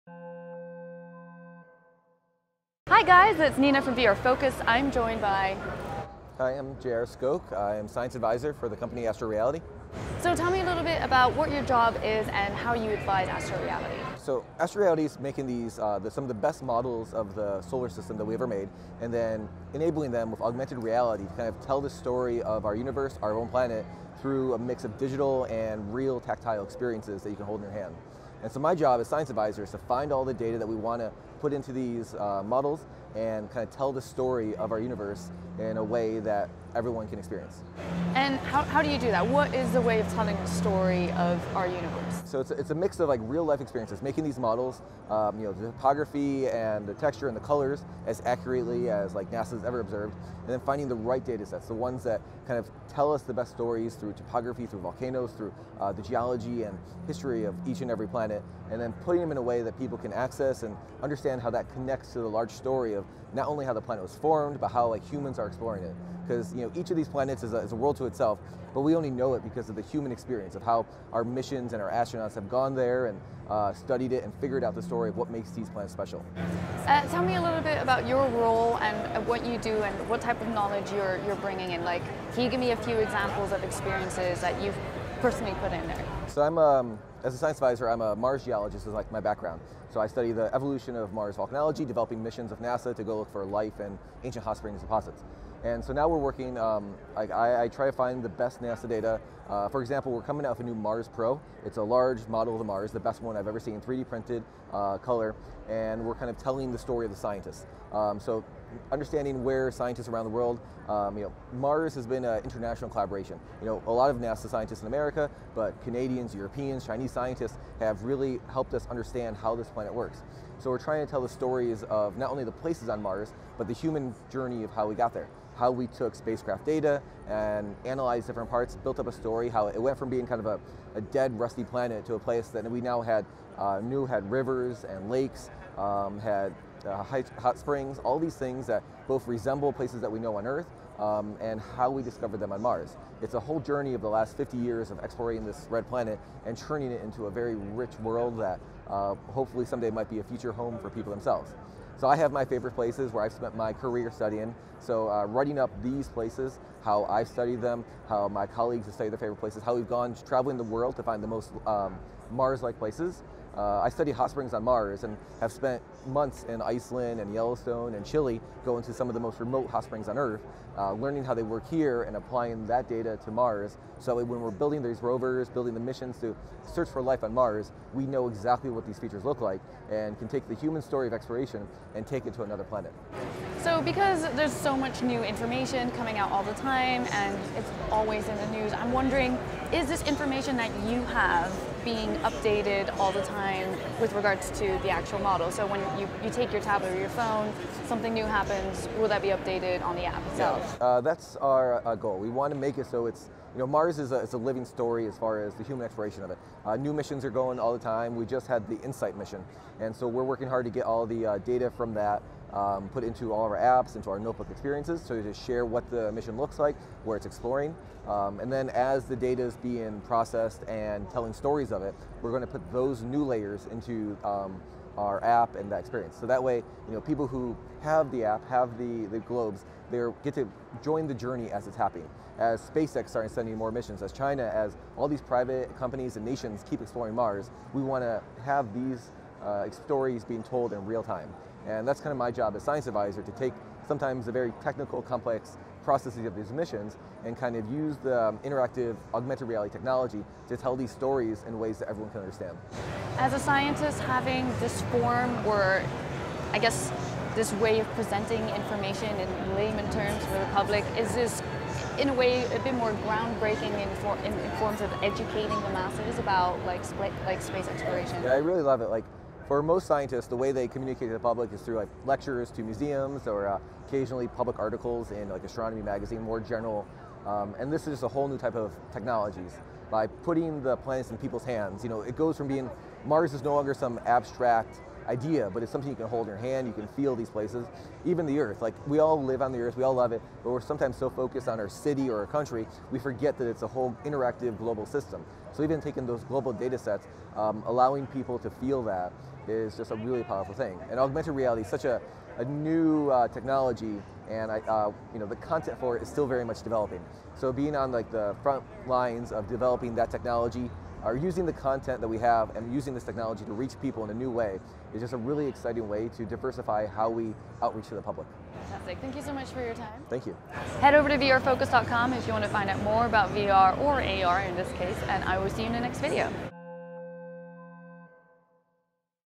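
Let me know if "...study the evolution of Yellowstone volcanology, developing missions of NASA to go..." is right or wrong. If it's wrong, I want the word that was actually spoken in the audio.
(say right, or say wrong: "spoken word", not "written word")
wrong: "Mars", not "Yellowstone".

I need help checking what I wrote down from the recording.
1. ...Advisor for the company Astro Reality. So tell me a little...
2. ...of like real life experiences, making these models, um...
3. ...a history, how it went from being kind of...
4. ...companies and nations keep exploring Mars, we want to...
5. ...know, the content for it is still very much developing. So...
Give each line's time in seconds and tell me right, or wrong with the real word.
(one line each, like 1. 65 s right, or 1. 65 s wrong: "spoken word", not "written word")
1. 8 s right
2. 43 s right
3. 129 s wrong: "story", not "history"
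4. 235 s right
5. 305 s right.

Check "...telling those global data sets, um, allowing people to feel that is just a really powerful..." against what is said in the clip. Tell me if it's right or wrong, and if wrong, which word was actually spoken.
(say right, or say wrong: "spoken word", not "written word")
wrong: "taking", not "telling".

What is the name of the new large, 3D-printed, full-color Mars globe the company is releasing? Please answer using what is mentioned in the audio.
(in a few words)
Mars Pro.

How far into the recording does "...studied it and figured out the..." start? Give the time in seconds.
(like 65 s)
73 s.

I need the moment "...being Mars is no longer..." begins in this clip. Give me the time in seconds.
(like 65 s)
282 s.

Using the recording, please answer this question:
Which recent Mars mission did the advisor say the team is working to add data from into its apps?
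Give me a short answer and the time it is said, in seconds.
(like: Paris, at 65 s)
InSight, at 208 s.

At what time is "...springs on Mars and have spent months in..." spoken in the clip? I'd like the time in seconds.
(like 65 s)
164 s.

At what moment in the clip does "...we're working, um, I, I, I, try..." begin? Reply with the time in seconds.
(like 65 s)
96 s.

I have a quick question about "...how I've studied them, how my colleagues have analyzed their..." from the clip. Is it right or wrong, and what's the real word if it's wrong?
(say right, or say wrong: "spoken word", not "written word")
wrong: "studied", not "analyzed".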